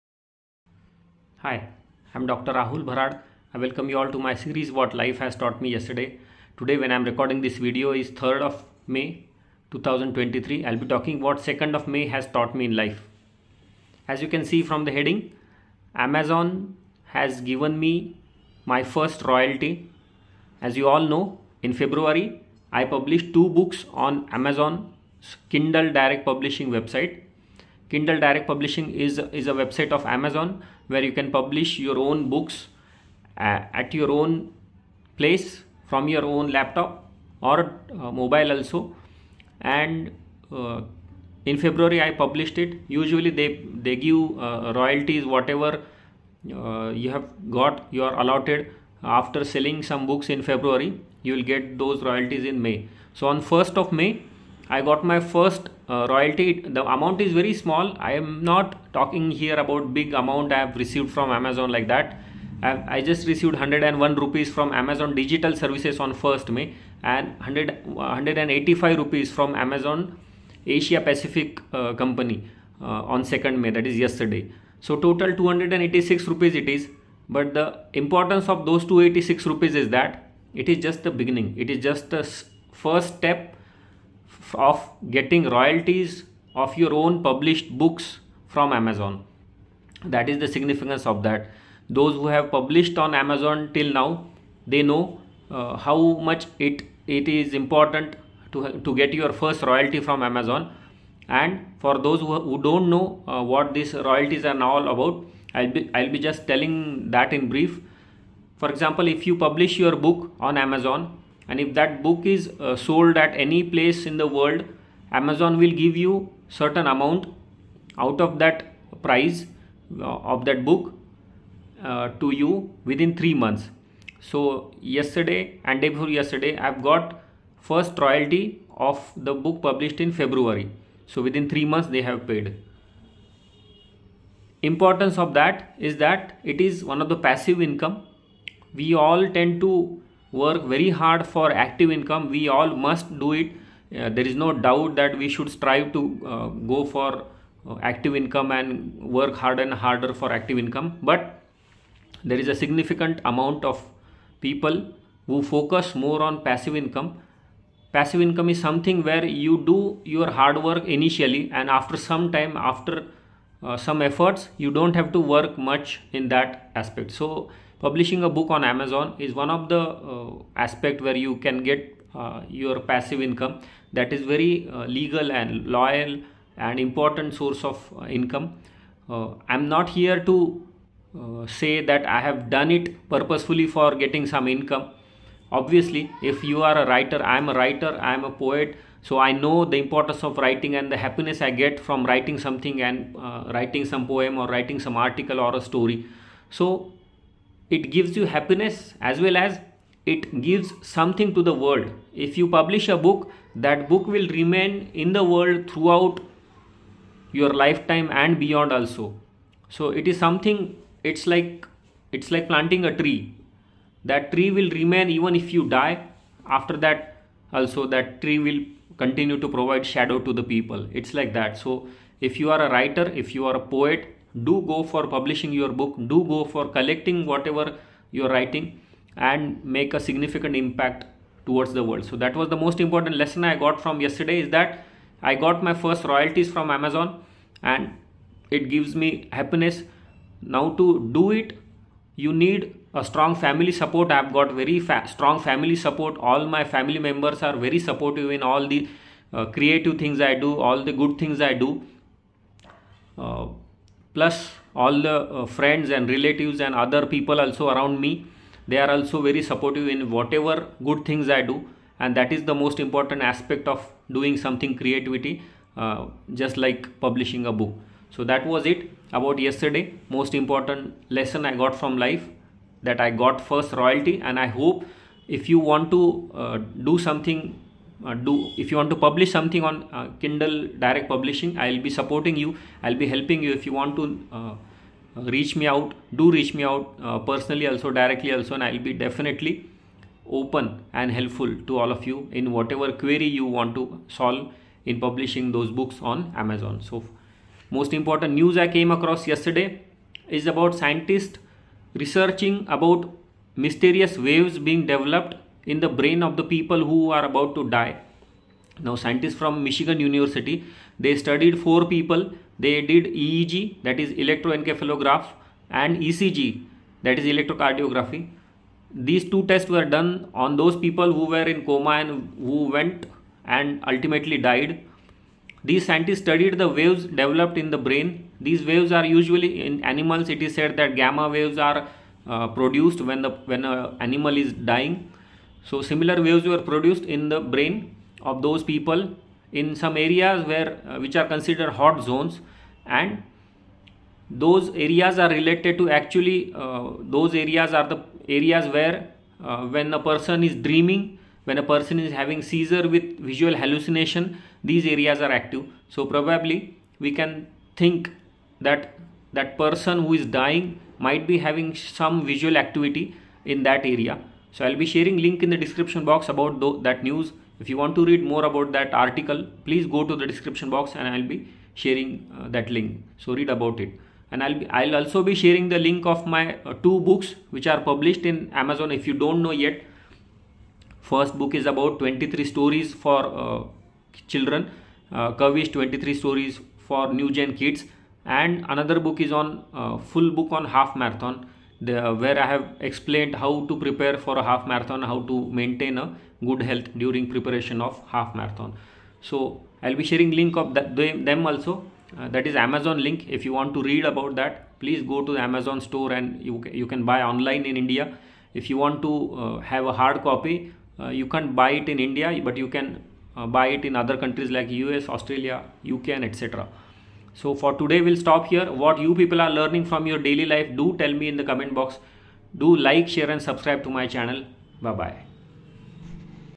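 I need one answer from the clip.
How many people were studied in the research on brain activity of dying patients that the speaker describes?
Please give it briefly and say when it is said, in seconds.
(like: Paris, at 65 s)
4, at 311 s.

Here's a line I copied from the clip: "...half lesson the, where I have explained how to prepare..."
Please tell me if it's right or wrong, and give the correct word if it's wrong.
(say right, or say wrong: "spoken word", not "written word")
wrong: "marathon", not "lesson".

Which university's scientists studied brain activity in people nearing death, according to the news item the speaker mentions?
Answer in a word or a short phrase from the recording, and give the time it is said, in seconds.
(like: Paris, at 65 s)
Michigan University, at 309 s.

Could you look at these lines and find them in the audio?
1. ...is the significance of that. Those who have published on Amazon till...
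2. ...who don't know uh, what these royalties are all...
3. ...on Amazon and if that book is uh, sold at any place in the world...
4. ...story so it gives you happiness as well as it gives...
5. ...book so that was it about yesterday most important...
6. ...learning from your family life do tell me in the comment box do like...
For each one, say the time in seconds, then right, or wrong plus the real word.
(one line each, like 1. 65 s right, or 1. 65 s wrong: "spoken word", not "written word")
1. 90 s right
2. 102 s right
3. 110 s right
4. 195 s right
5. 267 s right
6. 419 s wrong: "daily", not "family".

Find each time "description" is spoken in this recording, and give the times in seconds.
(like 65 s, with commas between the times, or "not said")
365 s, 370 s.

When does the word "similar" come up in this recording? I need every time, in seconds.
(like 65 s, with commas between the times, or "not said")
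335 s.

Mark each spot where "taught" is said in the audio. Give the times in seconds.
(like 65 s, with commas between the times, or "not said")
5 s, 12 s.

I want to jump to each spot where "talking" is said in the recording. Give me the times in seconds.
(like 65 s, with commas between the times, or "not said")
10 s, 58 s.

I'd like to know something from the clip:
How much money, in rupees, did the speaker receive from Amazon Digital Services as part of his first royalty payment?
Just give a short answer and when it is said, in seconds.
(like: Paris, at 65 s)
101 rupees, at 63 s.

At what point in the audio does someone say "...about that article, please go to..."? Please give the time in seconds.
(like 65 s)
368 s.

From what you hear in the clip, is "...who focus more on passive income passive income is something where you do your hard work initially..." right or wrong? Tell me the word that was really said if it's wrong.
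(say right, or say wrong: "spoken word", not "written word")
right.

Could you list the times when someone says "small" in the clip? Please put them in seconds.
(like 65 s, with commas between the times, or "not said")
57 s.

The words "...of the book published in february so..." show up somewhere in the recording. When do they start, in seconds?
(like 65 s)
128 s.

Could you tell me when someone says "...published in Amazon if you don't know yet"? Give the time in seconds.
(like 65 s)
377 s.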